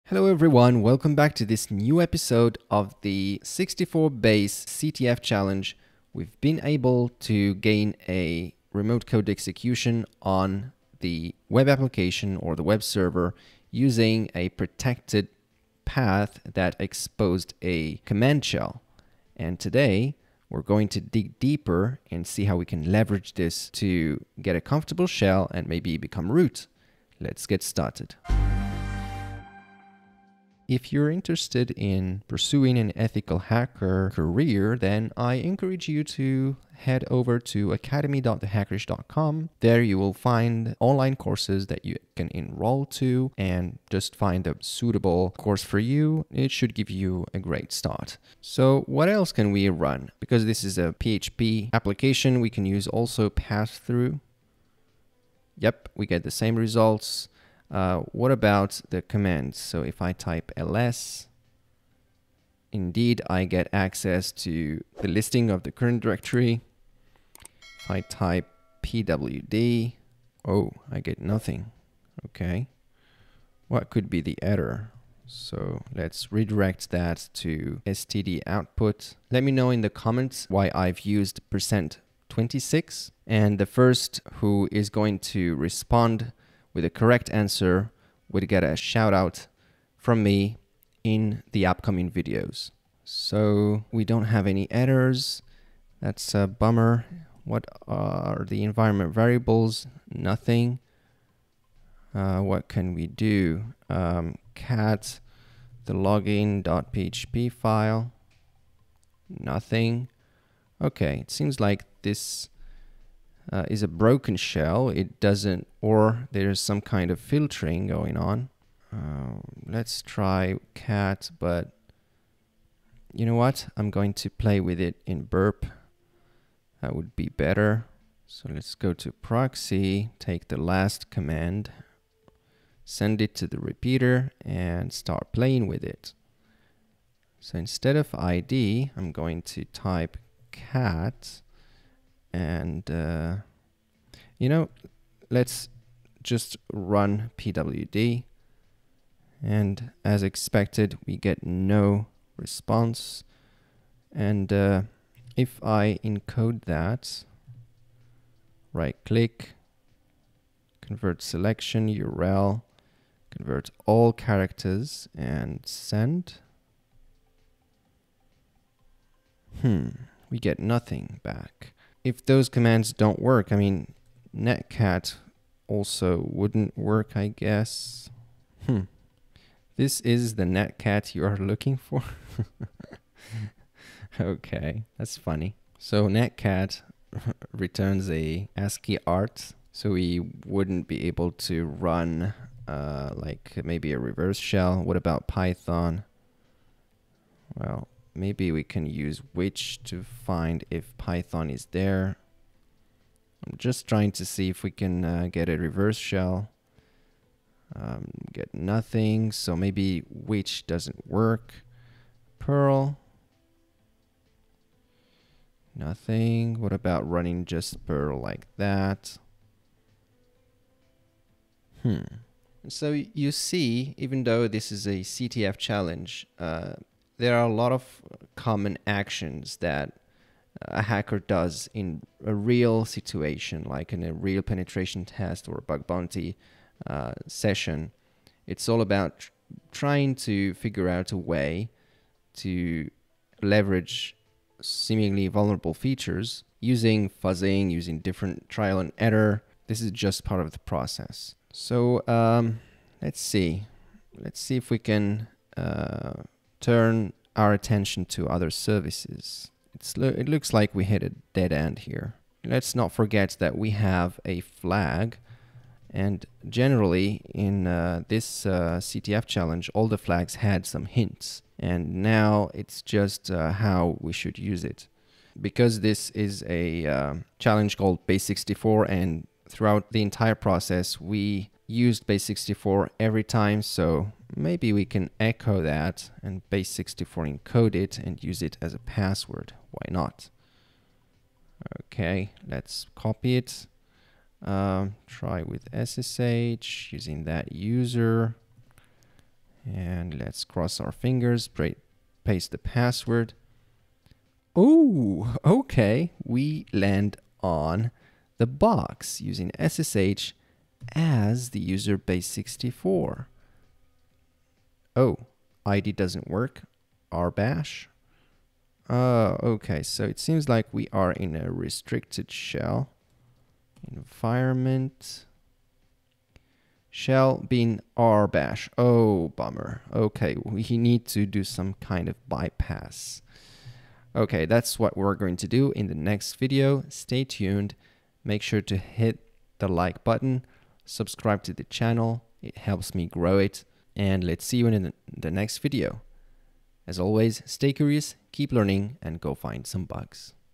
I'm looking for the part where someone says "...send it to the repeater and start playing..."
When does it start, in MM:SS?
02:12.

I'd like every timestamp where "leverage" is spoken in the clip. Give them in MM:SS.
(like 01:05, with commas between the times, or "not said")
00:22, 04:03.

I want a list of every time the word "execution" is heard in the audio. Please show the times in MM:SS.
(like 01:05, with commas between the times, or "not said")
00:09.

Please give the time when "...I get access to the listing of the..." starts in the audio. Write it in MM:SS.
01:03.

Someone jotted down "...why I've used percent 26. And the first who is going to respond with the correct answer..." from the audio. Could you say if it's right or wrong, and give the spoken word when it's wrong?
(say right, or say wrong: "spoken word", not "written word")
right.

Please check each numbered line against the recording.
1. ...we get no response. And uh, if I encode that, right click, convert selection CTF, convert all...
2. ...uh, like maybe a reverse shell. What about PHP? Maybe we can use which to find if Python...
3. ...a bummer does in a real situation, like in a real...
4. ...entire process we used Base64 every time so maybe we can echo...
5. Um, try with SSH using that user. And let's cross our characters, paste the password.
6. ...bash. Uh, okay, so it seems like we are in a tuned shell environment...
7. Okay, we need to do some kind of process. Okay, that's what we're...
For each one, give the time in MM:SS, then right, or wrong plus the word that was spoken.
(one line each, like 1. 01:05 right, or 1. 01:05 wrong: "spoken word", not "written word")
1. 02:31 wrong: "URL", not "CTF"
2. 03:12 wrong: "Python", not "PHP"
3. 03:50 wrong: "hacker", not "bummer"
4. 04:40 right
5. 04:54 wrong: "fingers", not "characters"
6. 05:17 wrong: "restricted", not "tuned"
7. 05:29 wrong: "bypass", not "process".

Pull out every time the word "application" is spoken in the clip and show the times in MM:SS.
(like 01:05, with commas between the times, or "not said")
00:11, 00:51.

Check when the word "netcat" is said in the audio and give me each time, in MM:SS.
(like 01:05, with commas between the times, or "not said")
02:54, 03:00, 03:06.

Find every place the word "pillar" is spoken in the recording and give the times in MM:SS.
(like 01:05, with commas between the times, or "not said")
not said.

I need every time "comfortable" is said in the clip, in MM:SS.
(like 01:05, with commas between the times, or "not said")
00:24.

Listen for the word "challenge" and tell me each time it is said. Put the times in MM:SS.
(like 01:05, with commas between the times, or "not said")
00:05, 03:45, 04:29, 04:37.